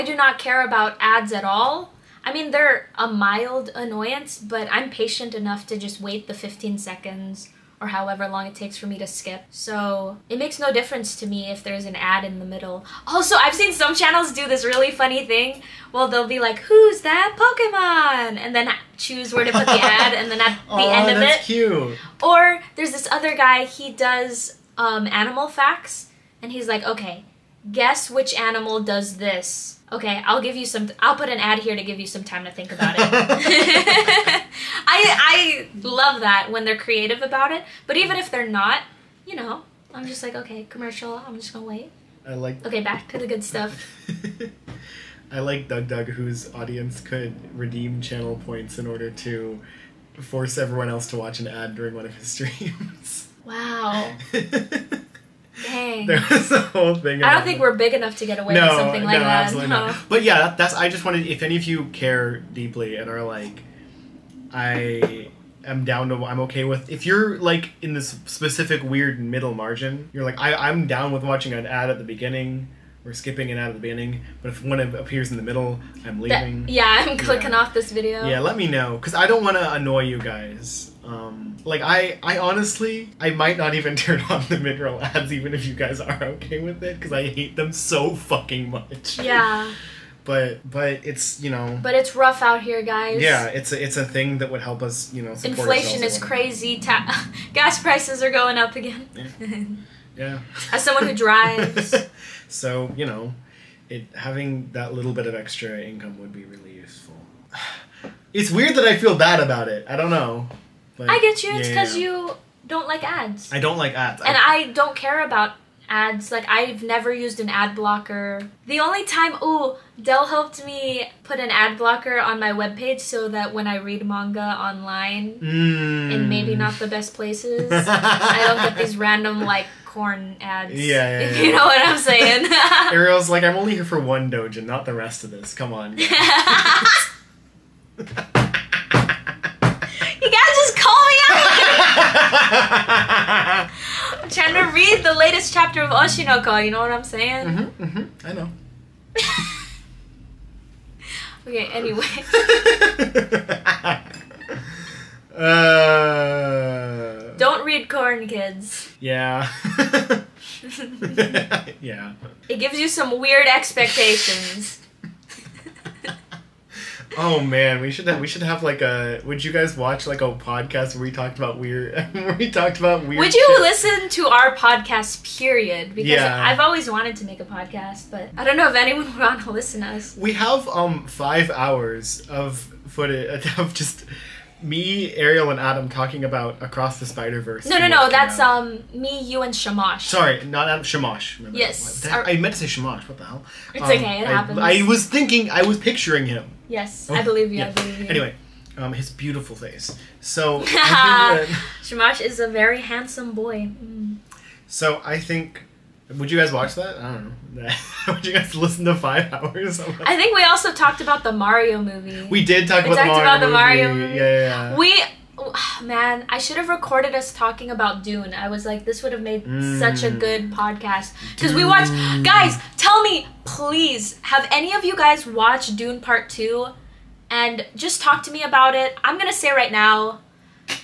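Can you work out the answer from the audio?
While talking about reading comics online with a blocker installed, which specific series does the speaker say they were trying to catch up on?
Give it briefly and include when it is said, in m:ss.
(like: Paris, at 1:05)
Oshi no Ko, at 2:25.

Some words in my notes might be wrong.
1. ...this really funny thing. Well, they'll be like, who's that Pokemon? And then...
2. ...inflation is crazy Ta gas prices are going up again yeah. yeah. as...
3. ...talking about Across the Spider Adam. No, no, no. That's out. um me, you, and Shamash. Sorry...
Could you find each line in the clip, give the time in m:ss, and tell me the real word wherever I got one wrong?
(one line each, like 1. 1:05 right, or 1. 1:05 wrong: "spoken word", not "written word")
1. 0:14 right
2. 1:35 right
3. 3:05 wrong: "Verse", not "Adam".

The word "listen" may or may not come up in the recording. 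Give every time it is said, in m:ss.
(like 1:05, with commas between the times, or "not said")
2:53, 2:59, 3:28.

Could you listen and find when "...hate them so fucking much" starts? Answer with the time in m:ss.
1:27.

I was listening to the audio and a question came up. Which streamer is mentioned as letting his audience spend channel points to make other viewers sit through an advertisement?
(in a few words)
DougDoug.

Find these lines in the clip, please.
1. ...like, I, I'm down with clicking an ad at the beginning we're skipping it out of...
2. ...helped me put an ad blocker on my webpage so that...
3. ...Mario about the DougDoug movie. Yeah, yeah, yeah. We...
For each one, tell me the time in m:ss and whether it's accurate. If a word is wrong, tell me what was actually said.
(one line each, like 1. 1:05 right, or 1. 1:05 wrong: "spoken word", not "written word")
1. 1:10 wrong: "watching", not "clicking"
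2. 2:00 right
3. 3:33 wrong: "Mario", not "DougDoug".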